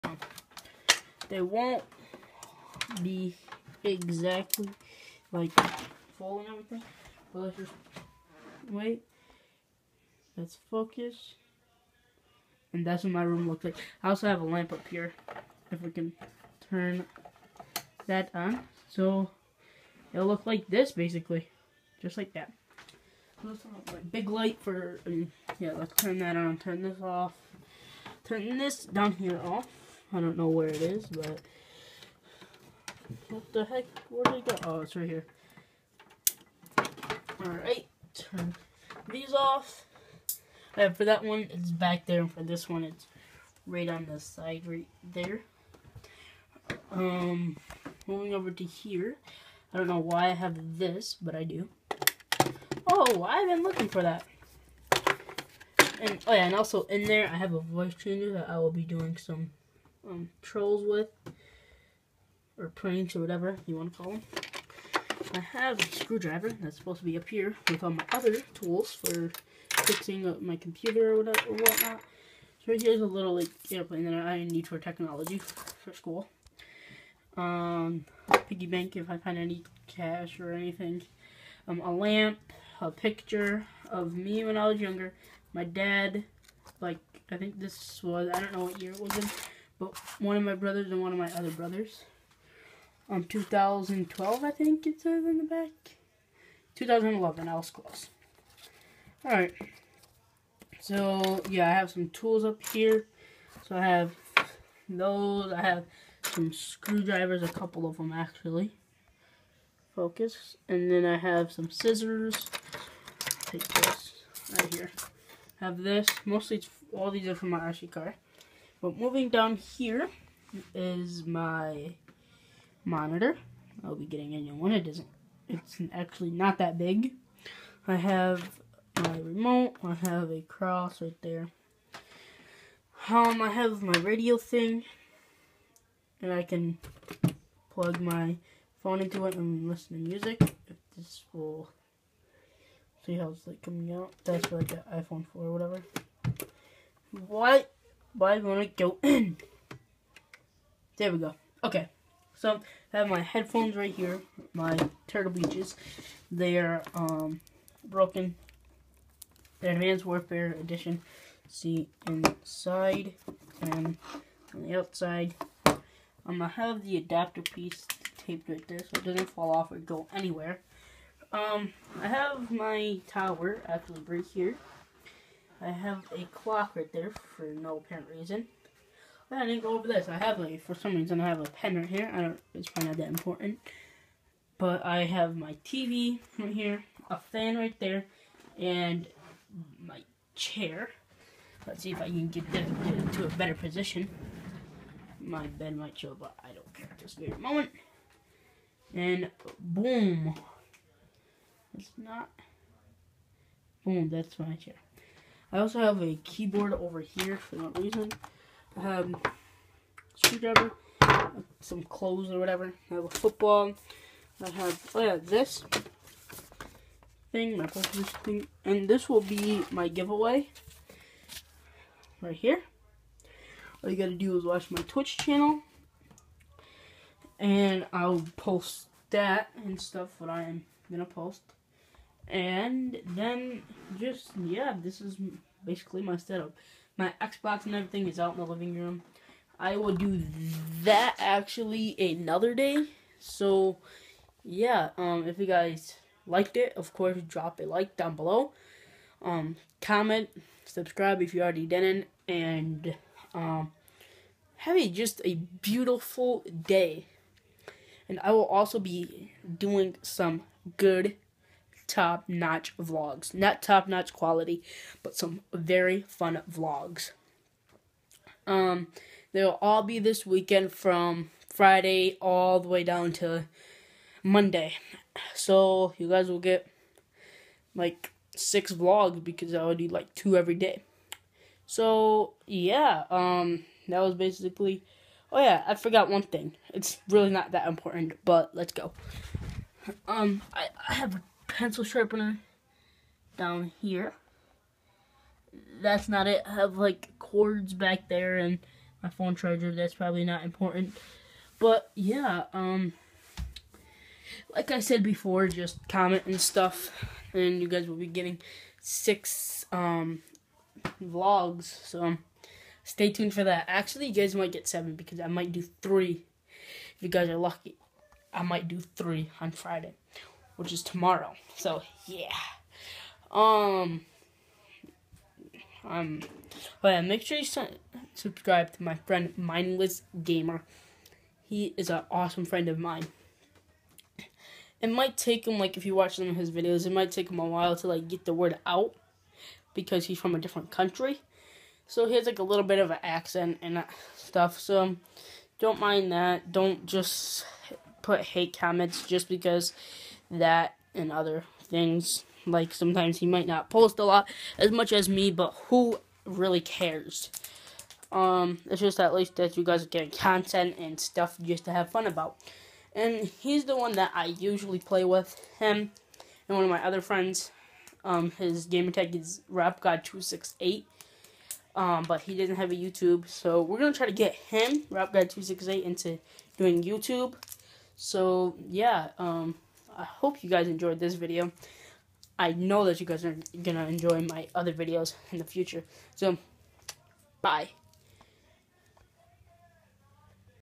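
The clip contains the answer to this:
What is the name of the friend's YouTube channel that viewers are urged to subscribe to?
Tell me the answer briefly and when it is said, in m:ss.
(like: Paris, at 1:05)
Mindless Gamer, at 5:29.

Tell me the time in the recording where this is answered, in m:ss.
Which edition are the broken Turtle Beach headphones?
2:39.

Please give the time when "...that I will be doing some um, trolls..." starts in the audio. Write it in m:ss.
0:58.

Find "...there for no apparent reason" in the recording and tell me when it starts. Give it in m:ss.
2:56.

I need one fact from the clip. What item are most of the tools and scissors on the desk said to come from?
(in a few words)
RC car.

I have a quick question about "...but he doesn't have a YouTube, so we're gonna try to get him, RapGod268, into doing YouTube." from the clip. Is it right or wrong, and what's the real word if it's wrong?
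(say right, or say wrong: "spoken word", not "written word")
right.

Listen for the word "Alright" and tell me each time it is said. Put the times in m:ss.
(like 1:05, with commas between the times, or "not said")
0:37, 1:39.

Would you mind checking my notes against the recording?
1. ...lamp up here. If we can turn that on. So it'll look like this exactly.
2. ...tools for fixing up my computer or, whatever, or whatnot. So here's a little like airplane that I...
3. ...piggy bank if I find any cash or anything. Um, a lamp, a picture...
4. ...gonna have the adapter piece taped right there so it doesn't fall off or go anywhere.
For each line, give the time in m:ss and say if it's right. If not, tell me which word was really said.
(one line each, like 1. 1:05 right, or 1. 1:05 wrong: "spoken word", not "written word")
1. 0:14 wrong: "basically", not "exactly"
2. 1:08 right
3. 1:18 right
4. 2:46 right.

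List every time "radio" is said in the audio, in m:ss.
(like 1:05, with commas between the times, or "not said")
2:13.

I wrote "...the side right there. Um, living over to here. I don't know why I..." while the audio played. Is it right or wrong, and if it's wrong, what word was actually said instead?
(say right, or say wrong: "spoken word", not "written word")
wrong: "moving", not "living".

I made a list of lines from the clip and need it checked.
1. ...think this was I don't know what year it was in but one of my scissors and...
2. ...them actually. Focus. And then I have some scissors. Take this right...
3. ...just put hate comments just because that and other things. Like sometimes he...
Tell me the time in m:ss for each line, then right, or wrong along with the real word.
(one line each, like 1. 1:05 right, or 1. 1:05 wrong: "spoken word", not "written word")
1. 1:27 wrong: "brothers", not "scissors"
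2. 1:47 right
3. 5:46 right.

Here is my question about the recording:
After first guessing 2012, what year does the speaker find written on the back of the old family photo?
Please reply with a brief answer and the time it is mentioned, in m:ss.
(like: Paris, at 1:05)
2011, at 1:36.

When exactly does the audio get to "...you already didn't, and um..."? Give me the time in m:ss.
4:11.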